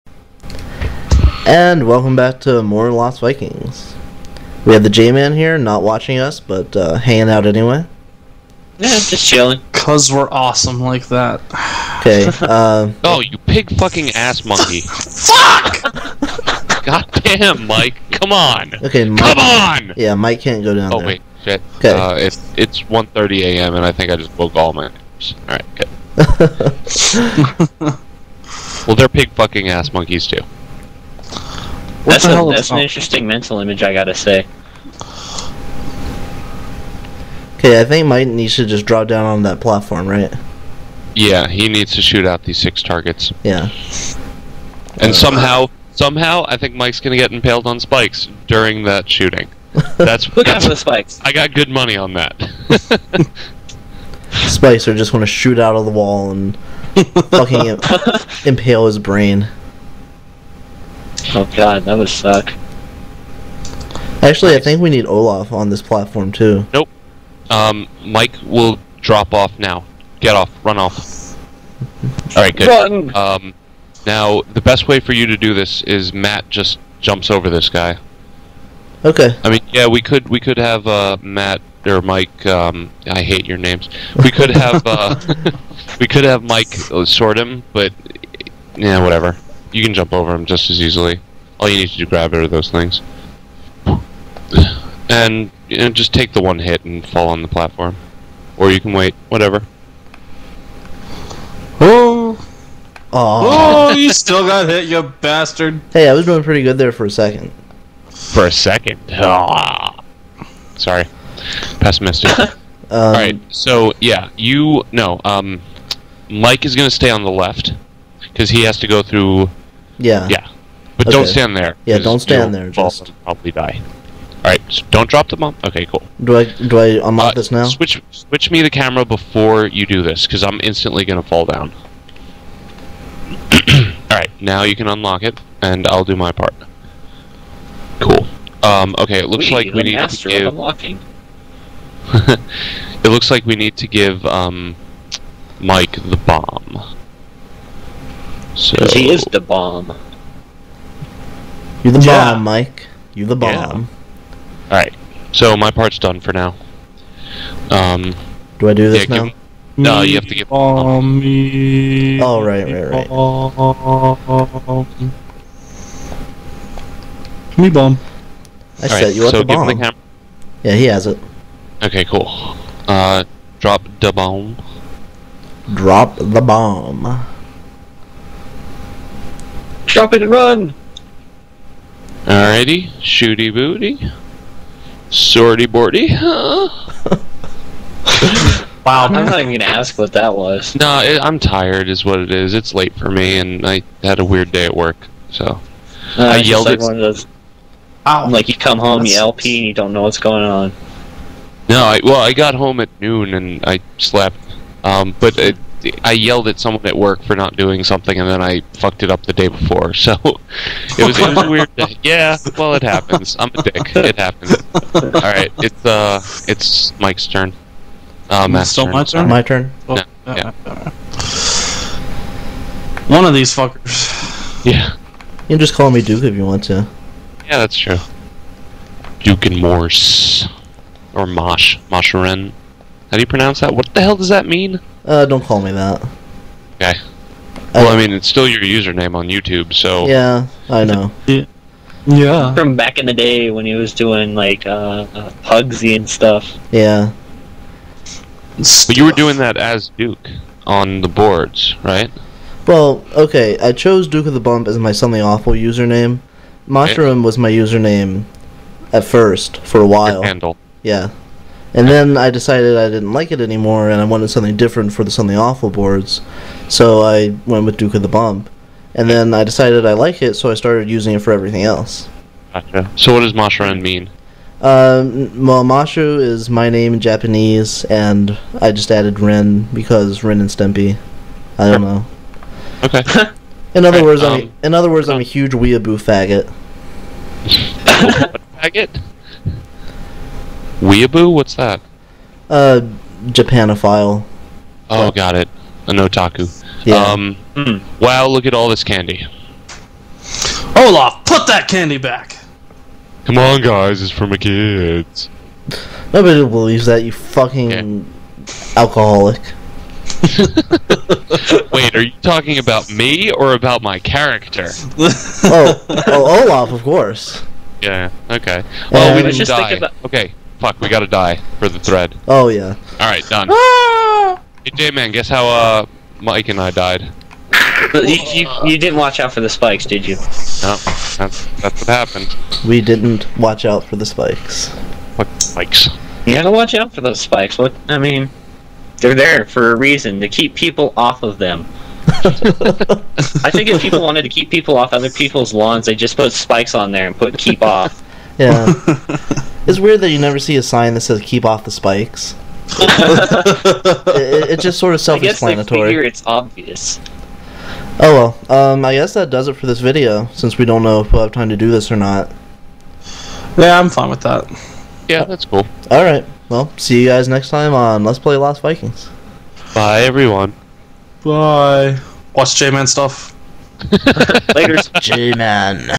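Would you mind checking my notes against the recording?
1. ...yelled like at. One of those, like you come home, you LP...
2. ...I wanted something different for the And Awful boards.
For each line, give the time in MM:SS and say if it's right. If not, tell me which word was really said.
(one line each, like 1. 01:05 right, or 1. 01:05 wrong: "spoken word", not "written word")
1. 03:16 right
2. 04:24 wrong: "Something", not "And".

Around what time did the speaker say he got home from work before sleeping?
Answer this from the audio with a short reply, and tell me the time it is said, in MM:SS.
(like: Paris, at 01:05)
noon, at 03:23.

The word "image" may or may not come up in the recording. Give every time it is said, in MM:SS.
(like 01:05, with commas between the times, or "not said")
00:33.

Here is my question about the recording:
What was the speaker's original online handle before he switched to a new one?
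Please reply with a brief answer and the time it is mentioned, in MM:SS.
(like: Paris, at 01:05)
Mushroom, at 04:16.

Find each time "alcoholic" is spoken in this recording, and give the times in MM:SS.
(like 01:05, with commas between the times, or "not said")
05:08.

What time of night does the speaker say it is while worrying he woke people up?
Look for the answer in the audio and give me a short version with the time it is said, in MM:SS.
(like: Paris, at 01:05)
1:30 a.m., at 00:22.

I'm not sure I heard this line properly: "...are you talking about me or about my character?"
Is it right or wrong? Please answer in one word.
right.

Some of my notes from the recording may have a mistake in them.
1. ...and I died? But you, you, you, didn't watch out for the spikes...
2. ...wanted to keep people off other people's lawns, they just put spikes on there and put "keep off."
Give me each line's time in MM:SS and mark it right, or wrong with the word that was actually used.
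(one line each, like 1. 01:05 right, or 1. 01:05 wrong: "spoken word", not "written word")
1. 05:26 right
2. 05:44 right.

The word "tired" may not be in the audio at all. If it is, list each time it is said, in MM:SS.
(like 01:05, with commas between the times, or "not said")
03:11.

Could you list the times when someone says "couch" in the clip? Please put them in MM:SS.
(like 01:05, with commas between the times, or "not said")
not said.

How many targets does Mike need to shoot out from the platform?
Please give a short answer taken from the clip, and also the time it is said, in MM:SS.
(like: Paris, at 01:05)
6, at 00:42.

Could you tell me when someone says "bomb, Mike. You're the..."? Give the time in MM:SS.
02:32.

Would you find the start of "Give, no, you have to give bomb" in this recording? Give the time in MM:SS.
02:39.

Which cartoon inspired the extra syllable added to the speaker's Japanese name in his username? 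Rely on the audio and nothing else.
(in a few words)
Ren and Stimpy.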